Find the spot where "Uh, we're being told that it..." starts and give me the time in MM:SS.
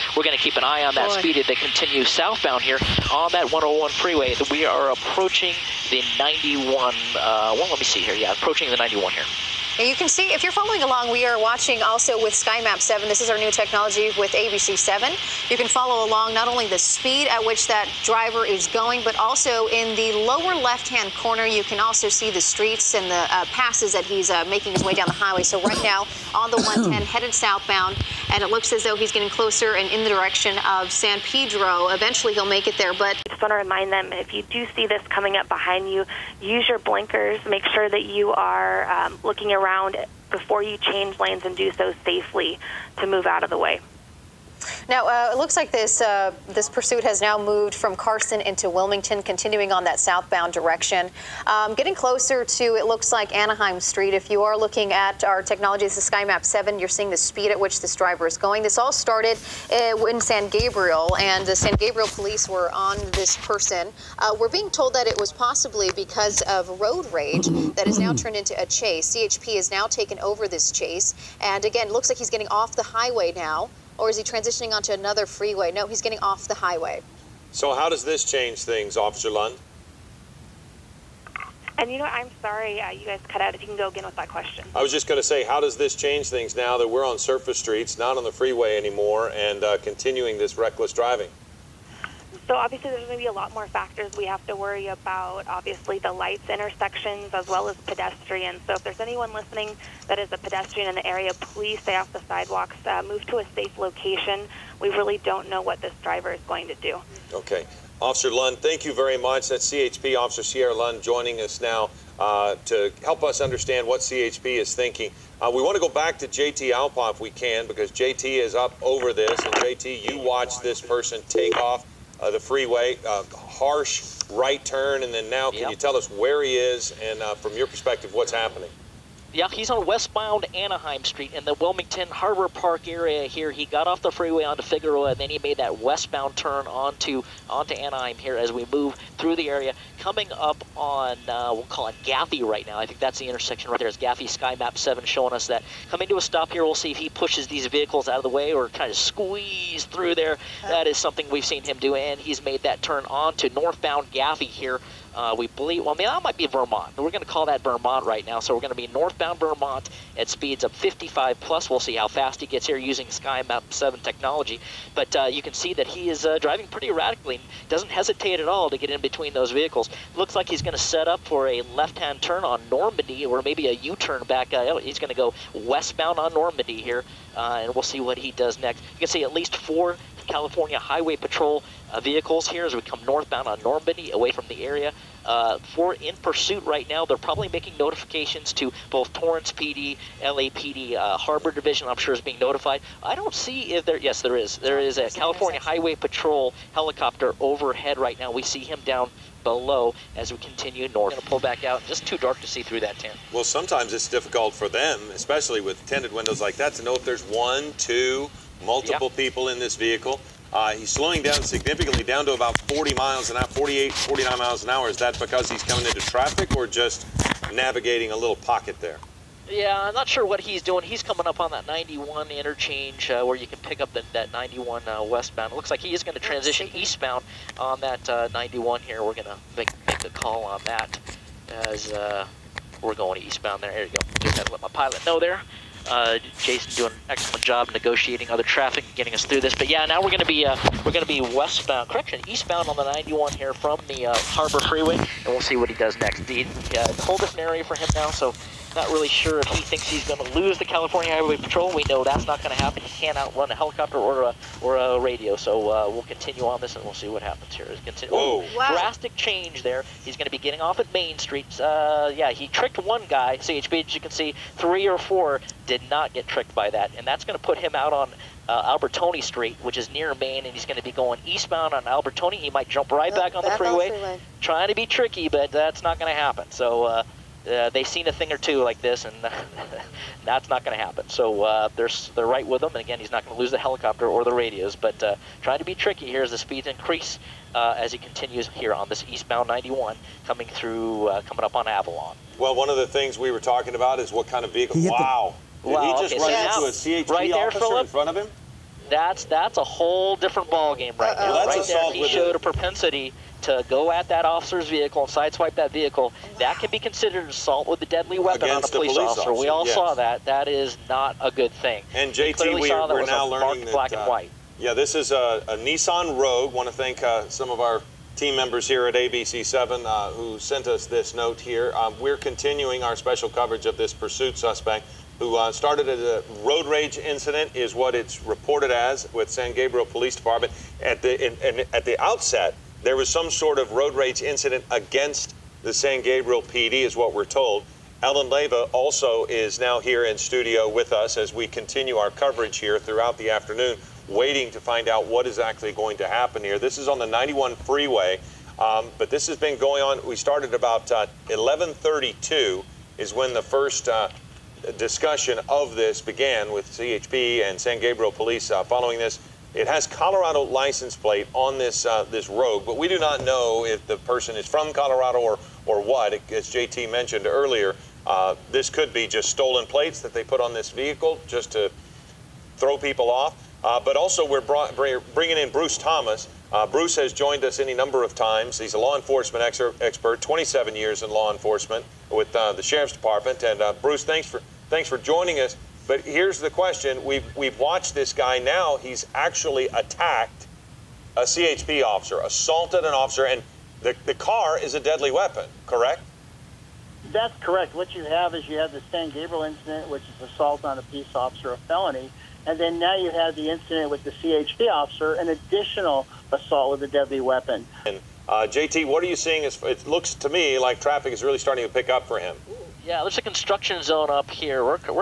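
01:04.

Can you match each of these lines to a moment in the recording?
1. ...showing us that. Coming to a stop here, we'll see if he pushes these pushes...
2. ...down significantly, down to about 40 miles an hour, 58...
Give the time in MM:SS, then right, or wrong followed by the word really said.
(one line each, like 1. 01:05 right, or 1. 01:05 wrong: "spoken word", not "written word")
1. 02:25 wrong: "vehicles", not "pushes"
2. 03:31 wrong: "48", not "58".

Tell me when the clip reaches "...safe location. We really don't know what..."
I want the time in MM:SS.
01:43.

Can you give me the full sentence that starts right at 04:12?
He cannot run a helicopter or a or a radio.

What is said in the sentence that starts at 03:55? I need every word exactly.
Uh, Jason doing an excellent job negotiating other traffic, getting us through this.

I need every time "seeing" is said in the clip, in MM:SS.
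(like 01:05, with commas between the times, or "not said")
00:56, 06:49.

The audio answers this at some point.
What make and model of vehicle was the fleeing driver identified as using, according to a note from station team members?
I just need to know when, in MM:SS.
05:15.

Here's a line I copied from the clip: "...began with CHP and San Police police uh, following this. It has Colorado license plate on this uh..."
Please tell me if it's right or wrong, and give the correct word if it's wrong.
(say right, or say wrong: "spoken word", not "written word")
wrong: "Gabriel", not "Police".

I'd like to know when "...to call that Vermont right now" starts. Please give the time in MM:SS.
02:37.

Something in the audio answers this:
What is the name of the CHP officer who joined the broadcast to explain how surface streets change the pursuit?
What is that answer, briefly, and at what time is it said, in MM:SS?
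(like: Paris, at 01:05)
Sierra Lund, at 01:50.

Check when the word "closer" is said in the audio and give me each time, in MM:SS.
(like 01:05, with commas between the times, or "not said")
00:29, 00:51.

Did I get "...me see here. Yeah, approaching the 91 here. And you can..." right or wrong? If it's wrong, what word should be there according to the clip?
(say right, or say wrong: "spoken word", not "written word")
right.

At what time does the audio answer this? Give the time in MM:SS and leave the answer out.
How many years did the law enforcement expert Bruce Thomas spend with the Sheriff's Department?
06:20.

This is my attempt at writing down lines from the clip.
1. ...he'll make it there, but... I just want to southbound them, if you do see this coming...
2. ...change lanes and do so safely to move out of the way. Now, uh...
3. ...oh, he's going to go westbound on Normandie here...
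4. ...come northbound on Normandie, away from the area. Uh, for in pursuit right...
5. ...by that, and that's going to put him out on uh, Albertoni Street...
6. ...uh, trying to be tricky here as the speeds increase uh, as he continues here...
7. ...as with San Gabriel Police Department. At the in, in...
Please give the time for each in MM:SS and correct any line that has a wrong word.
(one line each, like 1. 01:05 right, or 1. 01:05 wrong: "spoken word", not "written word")
1. 00:32 wrong: "remind", not "southbound"
2. 00:40 right
3. 02:54 right
4. 03:02 right
5. 04:26 right
6. 04:45 right
7. 05:28 right.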